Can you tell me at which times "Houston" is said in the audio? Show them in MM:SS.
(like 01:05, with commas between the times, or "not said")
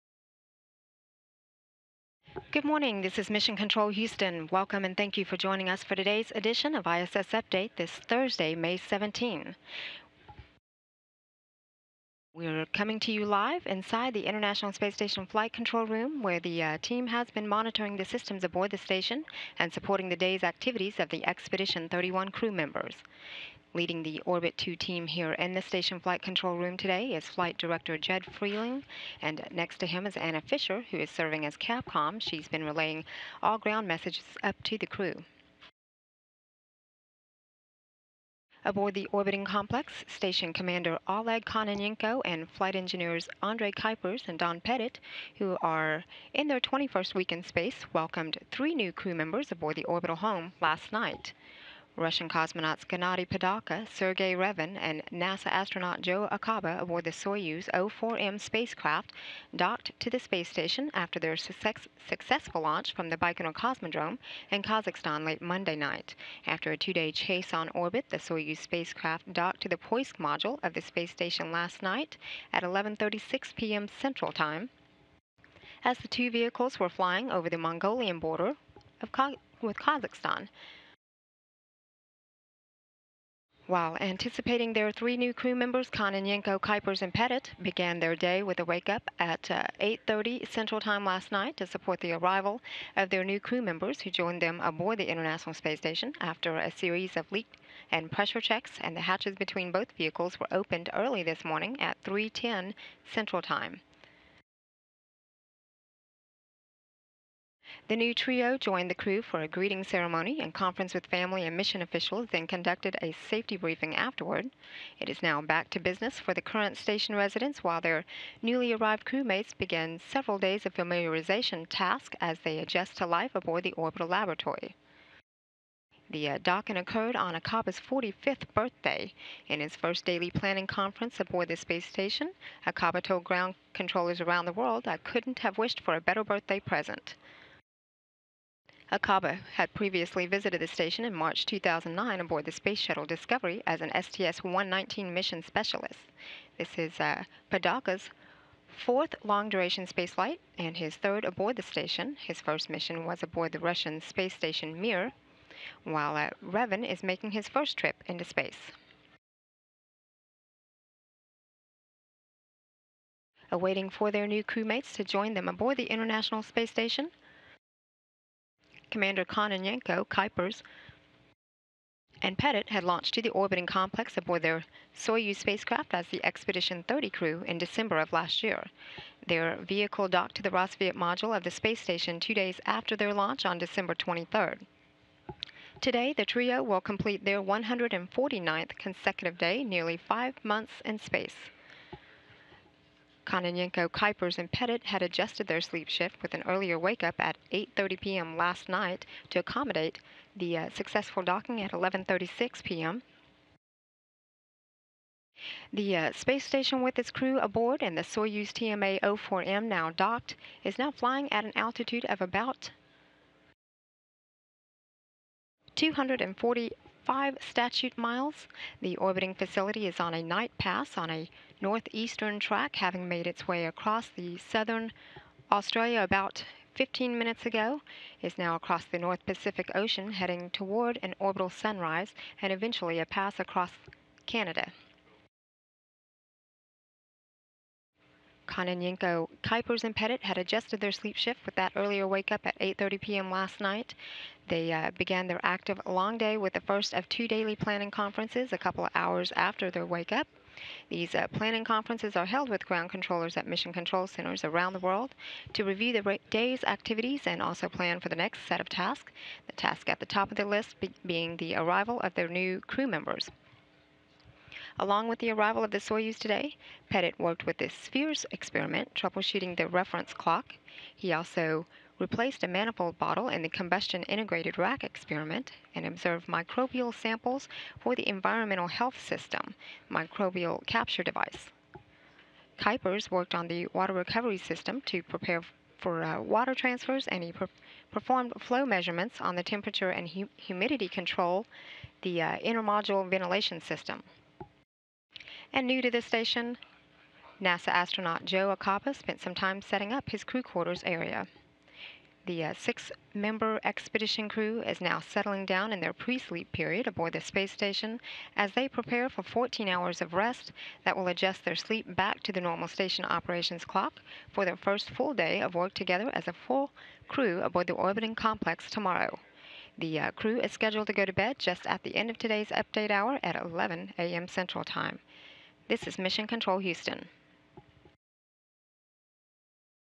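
00:03, 05:26.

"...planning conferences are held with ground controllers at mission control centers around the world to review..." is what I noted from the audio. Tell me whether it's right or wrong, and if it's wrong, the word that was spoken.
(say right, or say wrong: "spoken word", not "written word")
right.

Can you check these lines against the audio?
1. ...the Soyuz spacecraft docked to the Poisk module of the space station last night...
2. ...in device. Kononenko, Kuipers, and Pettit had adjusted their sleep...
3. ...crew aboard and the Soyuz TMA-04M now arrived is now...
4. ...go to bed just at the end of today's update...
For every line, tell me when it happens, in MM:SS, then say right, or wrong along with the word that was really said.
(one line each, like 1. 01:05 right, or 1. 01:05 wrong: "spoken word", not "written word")
1. 01:08 right
2. 03:10 wrong: "space", not "device"
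3. 03:27 wrong: "docked", not "arrived"
4. 05:20 right.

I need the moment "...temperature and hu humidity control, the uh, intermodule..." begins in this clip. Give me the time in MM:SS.
04:49.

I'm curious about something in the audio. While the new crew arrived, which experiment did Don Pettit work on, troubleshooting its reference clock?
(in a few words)
Spheres.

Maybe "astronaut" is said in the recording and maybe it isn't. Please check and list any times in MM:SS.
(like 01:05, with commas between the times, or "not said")
00:55, 04:57.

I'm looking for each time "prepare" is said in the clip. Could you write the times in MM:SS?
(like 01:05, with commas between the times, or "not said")
04:45, 05:08.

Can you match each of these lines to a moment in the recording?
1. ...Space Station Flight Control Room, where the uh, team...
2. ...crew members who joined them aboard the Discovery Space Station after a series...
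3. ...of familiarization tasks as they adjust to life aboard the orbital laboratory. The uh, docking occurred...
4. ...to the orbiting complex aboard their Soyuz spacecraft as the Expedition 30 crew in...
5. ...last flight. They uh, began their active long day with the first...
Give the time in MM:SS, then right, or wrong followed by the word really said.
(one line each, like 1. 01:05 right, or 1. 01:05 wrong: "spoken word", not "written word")
1. 00:14 right
2. 01:33 wrong: "International", not "Discovery"
3. 02:00 right
4. 02:53 right
5. 04:03 wrong: "night", not "flight".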